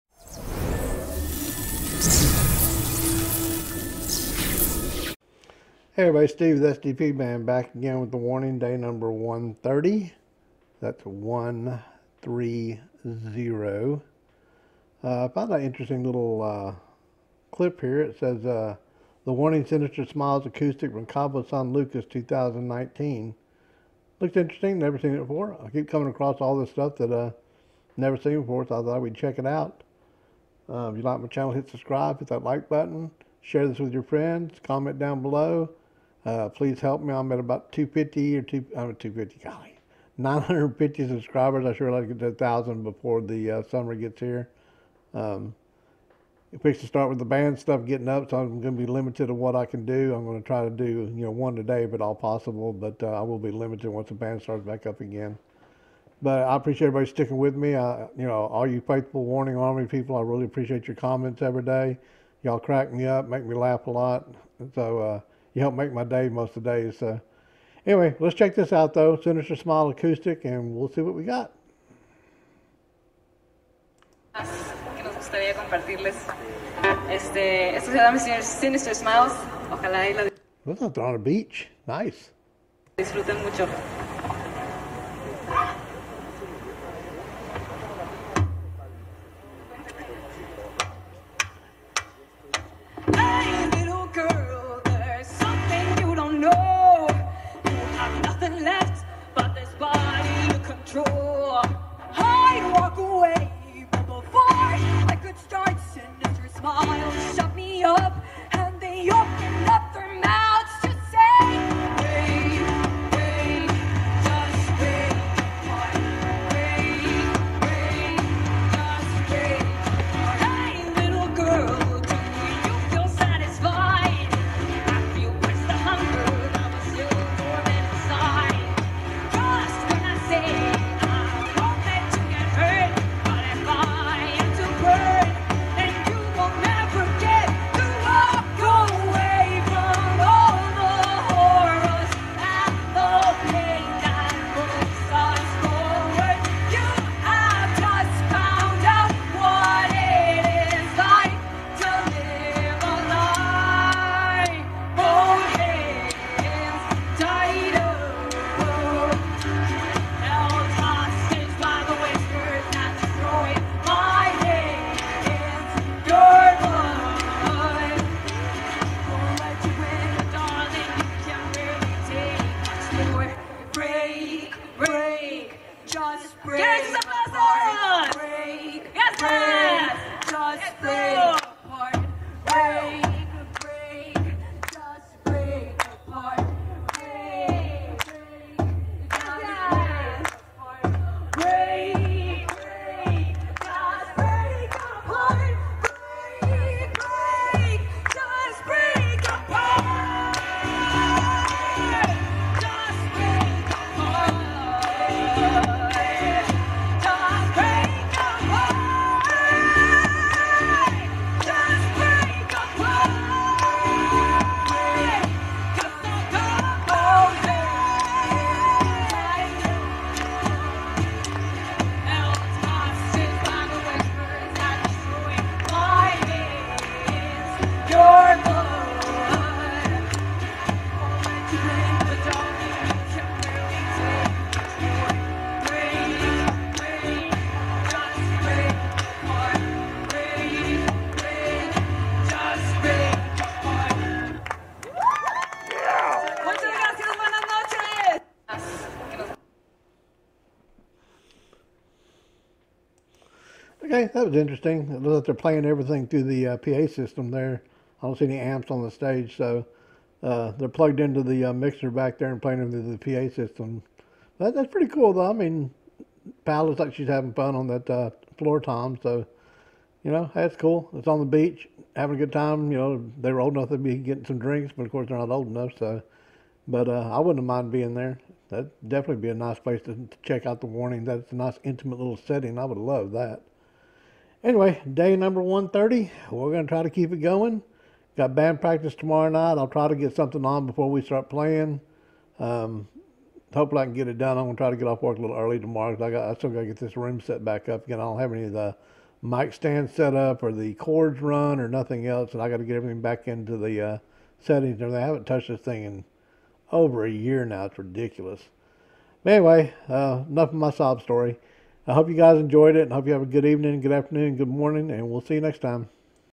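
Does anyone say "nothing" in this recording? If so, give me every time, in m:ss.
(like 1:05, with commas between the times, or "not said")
5:01.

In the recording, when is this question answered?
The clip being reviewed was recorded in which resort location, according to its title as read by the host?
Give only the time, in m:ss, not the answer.
0:21.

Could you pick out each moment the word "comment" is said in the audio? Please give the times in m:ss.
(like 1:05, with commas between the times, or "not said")
0:34, 1:00.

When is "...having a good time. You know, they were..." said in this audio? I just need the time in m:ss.
4:31.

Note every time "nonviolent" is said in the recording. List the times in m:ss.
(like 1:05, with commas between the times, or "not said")
not said.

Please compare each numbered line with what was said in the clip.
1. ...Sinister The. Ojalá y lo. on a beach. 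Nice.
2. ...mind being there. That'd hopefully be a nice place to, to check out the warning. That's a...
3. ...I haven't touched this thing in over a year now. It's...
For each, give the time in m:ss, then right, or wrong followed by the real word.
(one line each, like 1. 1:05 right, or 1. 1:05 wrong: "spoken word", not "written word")
1. 1:18 wrong: "Smiles", not "The"
2. 4:37 wrong: "definitely", not "hopefully"
3. 5:04 right.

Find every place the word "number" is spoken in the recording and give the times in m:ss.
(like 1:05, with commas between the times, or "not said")
0:08, 4:45.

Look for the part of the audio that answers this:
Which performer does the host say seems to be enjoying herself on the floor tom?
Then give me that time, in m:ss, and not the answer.
4:26.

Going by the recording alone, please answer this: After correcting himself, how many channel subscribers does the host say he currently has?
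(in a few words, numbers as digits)
950.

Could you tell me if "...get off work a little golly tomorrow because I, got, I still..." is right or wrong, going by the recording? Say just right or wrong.
wrong.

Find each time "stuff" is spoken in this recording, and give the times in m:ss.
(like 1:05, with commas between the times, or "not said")
0:26, 0:47.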